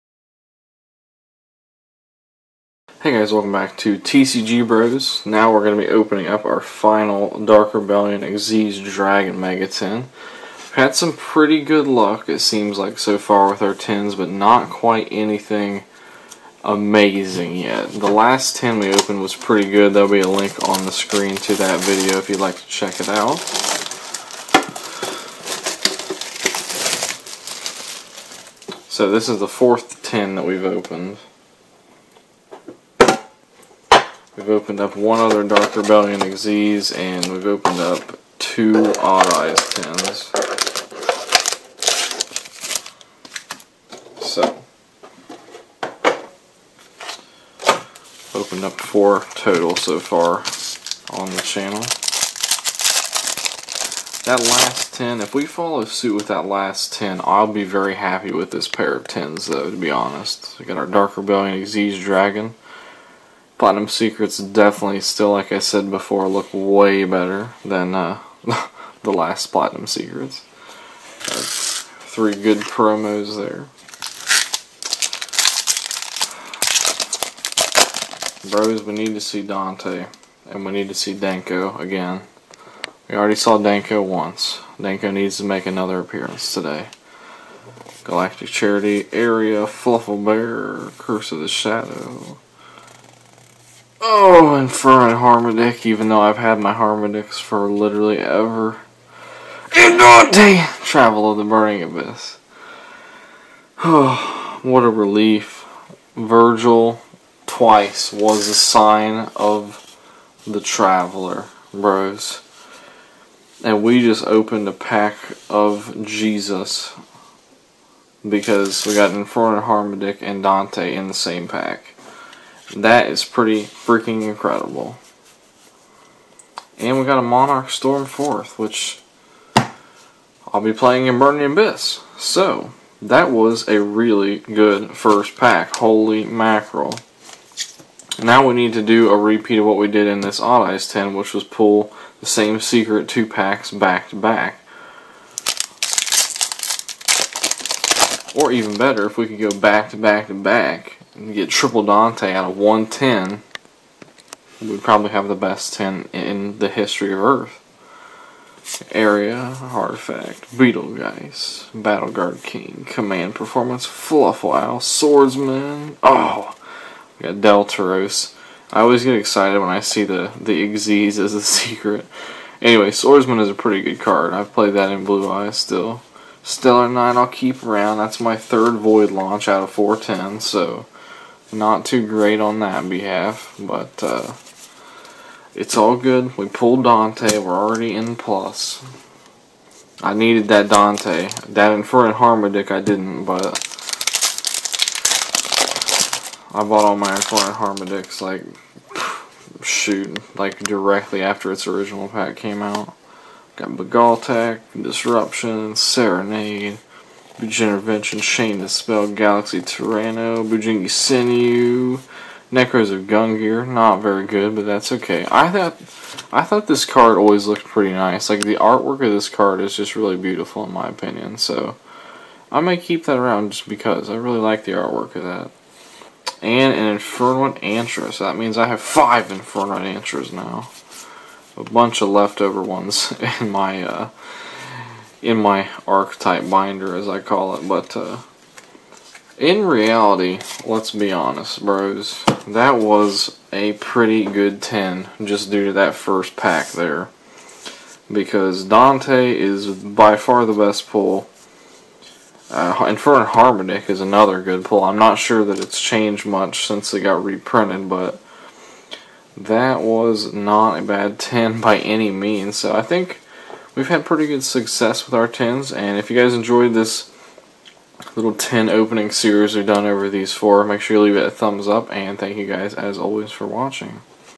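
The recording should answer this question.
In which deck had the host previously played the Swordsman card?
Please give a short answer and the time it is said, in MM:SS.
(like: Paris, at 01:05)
Blue Eyes, at 02:55.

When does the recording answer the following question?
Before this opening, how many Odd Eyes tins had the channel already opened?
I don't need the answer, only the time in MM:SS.
00:38.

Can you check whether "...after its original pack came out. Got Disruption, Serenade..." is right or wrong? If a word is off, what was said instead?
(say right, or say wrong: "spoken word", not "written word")
right.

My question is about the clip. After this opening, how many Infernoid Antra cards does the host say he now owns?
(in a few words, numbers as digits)
5.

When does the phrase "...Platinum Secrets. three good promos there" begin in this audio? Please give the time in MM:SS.
01:09.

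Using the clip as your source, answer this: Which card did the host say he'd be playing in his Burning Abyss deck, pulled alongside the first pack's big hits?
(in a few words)
Monarch Stormforth.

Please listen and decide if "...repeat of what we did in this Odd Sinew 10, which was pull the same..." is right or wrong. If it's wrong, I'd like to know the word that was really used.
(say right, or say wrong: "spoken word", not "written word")
wrong: "Eyes", not "Sinew".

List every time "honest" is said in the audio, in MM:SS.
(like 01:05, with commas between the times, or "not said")
00:59, 04:01.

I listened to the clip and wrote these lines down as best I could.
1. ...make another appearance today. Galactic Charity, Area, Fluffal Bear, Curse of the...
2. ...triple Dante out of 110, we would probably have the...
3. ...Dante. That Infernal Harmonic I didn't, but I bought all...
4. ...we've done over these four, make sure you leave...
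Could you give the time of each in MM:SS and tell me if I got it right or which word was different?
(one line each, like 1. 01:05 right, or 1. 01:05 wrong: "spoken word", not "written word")
1. 01:25 right
2. 02:31 right
3. 03:10 right
4. 04:29 right.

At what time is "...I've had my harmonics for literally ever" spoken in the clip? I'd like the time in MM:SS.
01:36.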